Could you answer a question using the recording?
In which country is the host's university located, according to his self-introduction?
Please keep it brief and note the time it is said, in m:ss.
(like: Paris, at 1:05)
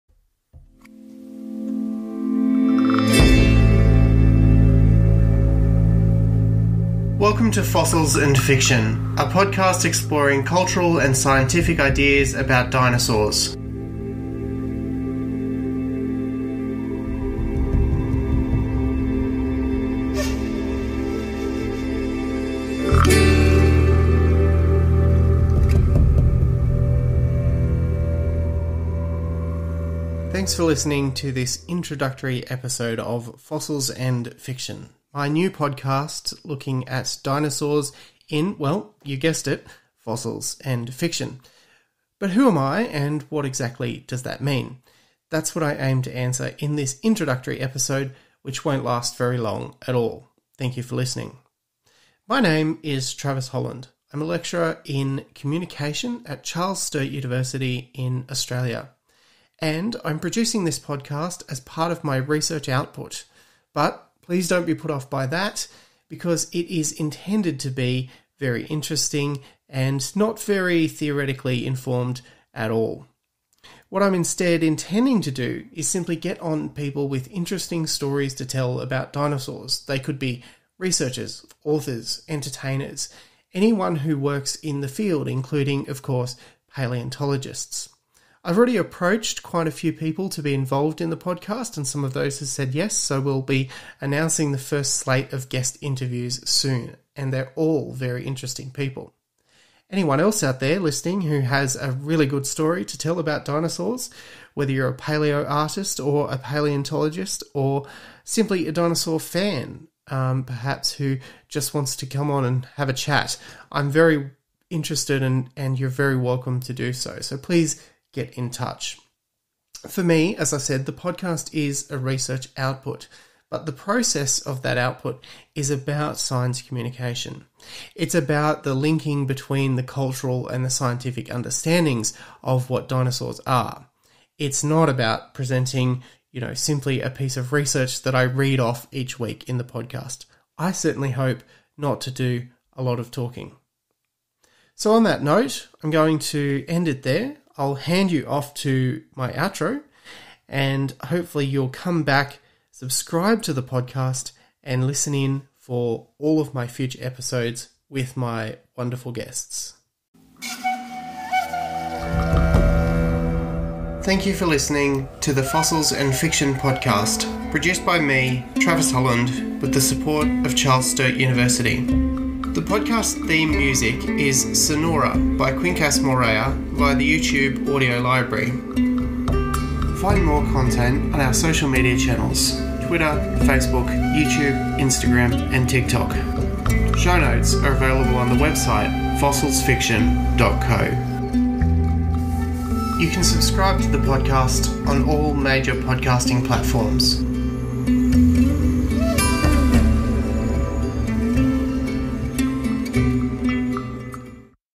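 Australia, at 0:58.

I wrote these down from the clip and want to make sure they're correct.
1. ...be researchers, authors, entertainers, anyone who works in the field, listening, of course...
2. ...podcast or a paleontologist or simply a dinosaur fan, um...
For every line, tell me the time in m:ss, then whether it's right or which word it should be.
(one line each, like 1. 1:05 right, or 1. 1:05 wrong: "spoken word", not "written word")
1. 1:20 wrong: "including", not "listening"
2. 1:45 wrong: "artist", not "podcast".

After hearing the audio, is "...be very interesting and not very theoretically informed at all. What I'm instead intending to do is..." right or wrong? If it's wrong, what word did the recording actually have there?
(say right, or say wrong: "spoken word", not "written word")
right.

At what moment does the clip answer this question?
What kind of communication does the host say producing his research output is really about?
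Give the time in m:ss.
2:06.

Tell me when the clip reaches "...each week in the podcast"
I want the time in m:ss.
2:18.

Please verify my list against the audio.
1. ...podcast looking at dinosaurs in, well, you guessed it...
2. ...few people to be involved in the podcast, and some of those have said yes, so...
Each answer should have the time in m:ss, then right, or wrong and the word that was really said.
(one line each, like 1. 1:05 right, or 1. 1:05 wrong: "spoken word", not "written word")
1. 0:35 right
2. 1:29 right.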